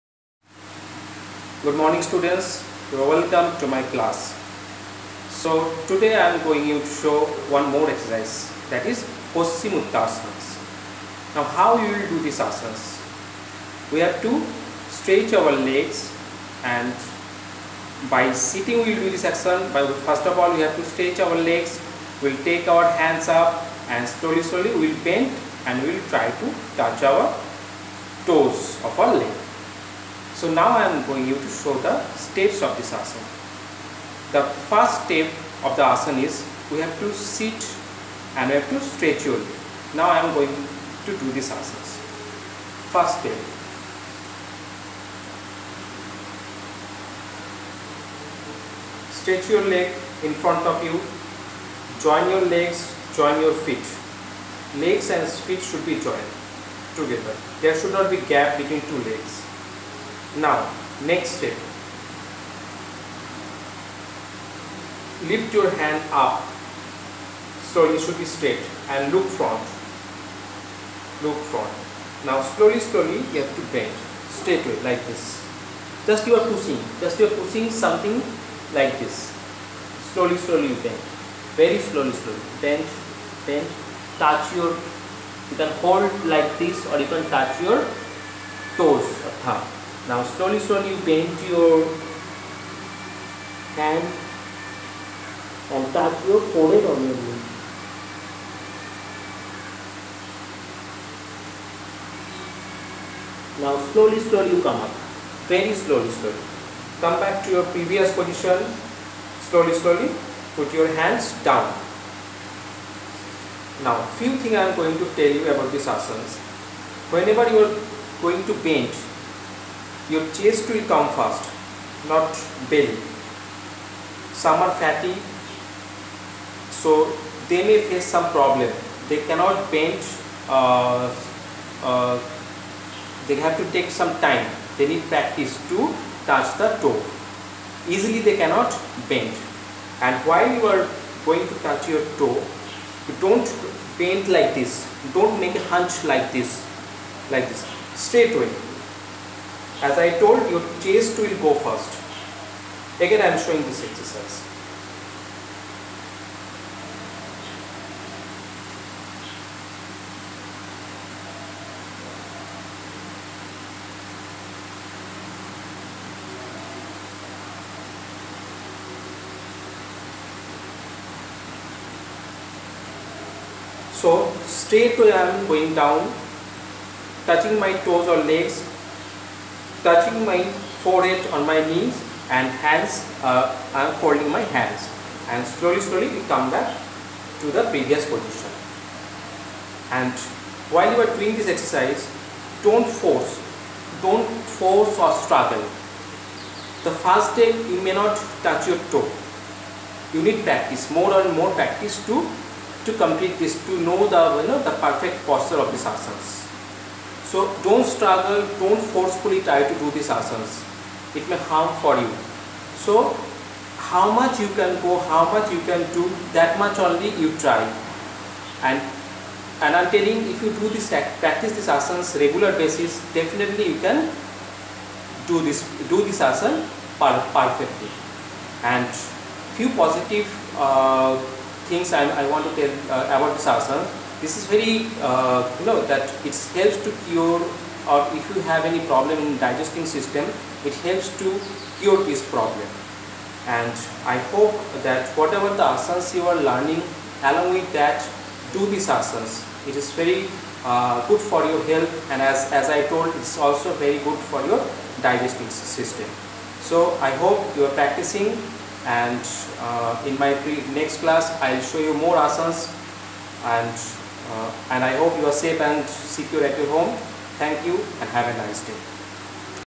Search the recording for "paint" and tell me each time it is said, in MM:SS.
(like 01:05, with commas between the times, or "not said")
02:09, 02:24.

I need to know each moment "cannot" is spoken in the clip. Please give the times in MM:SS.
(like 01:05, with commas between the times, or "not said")
02:09, 02:18.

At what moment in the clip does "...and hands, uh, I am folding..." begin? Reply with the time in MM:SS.
03:02.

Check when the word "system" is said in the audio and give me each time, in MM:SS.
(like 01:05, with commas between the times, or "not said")
03:59, 04:15.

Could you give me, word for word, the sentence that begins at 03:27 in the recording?
So don't struggle, don't forcefully try to do these asanas.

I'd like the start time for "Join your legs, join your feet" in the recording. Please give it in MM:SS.
00:52.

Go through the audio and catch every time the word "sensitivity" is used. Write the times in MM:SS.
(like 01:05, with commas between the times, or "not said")
not said.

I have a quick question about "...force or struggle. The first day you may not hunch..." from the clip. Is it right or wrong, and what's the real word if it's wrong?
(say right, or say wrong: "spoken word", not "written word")
wrong: "touch", not "hunch".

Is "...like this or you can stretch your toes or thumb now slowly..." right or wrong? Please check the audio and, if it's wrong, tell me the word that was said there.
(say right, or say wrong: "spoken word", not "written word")
wrong: "touch", not "stretch".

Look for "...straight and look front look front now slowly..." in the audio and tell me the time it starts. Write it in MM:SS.
01:08.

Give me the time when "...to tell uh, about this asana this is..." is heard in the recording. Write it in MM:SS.
03:52.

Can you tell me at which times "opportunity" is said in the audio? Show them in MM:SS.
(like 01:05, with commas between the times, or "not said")
not said.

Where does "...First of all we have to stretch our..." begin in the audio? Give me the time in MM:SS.
00:20.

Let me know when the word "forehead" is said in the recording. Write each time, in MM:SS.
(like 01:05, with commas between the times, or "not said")
01:36, 03:00.